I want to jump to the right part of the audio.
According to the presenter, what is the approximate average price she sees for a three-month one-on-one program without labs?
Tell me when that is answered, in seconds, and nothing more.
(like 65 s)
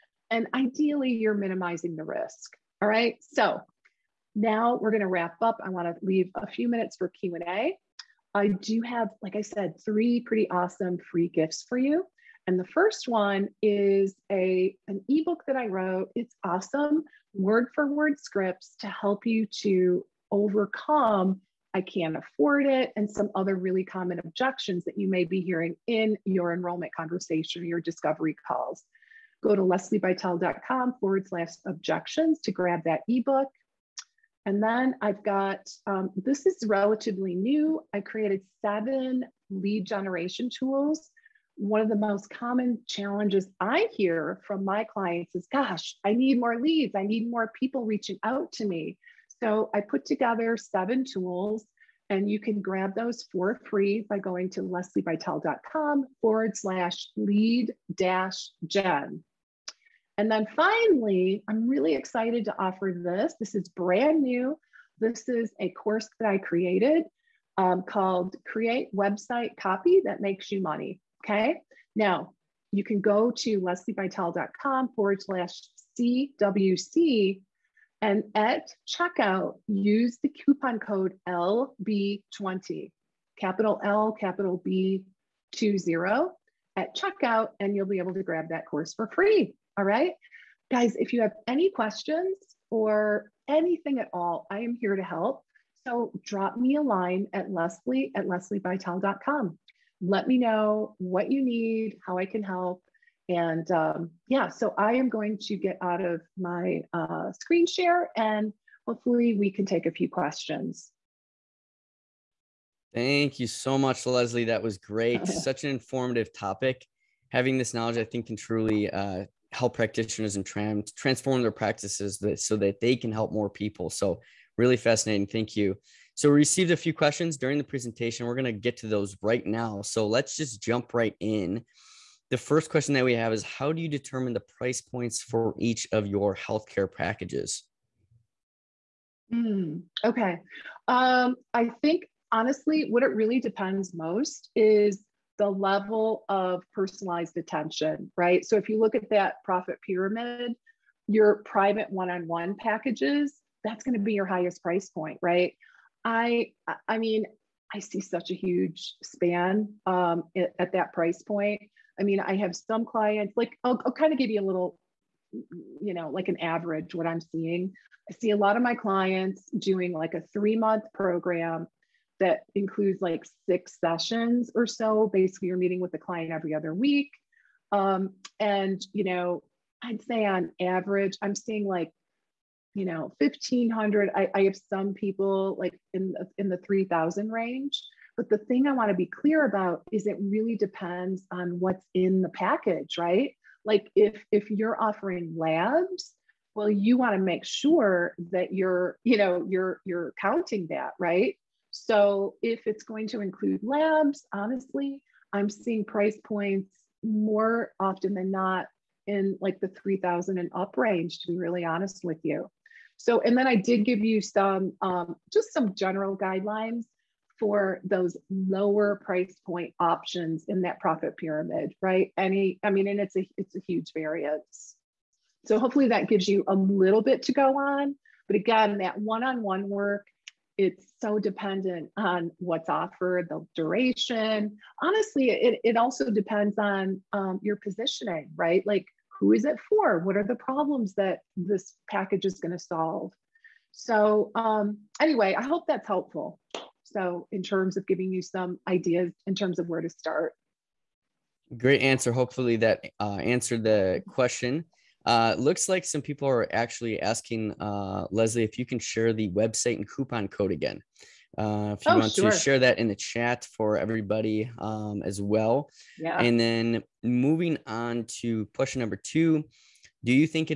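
183 s.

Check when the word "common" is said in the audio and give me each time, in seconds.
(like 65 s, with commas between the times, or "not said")
23 s, 42 s.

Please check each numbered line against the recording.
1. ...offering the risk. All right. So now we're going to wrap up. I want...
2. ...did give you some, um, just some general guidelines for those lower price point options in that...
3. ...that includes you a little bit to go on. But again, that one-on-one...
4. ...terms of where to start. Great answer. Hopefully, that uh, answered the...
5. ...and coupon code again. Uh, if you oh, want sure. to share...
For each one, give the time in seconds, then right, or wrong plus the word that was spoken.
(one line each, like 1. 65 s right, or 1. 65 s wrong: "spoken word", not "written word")
1. 1 s wrong: "minimizing", not "offering"
2. 213 s right
3. 225 s wrong: "gives", not "includes"
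4. 249 s right
5. 259 s right.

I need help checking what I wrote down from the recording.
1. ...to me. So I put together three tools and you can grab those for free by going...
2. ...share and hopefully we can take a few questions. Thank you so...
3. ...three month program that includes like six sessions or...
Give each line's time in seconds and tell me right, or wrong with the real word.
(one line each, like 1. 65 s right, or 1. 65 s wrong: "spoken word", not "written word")
1. 48 s wrong: "seven", not "three"
2. 107 s right
3. 170 s right.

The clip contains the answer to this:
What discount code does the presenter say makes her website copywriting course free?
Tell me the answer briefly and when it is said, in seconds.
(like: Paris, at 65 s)
LB20, at 81 s.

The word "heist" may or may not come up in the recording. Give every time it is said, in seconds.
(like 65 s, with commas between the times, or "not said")
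not said.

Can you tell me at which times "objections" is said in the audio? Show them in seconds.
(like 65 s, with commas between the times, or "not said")
24 s, 31 s.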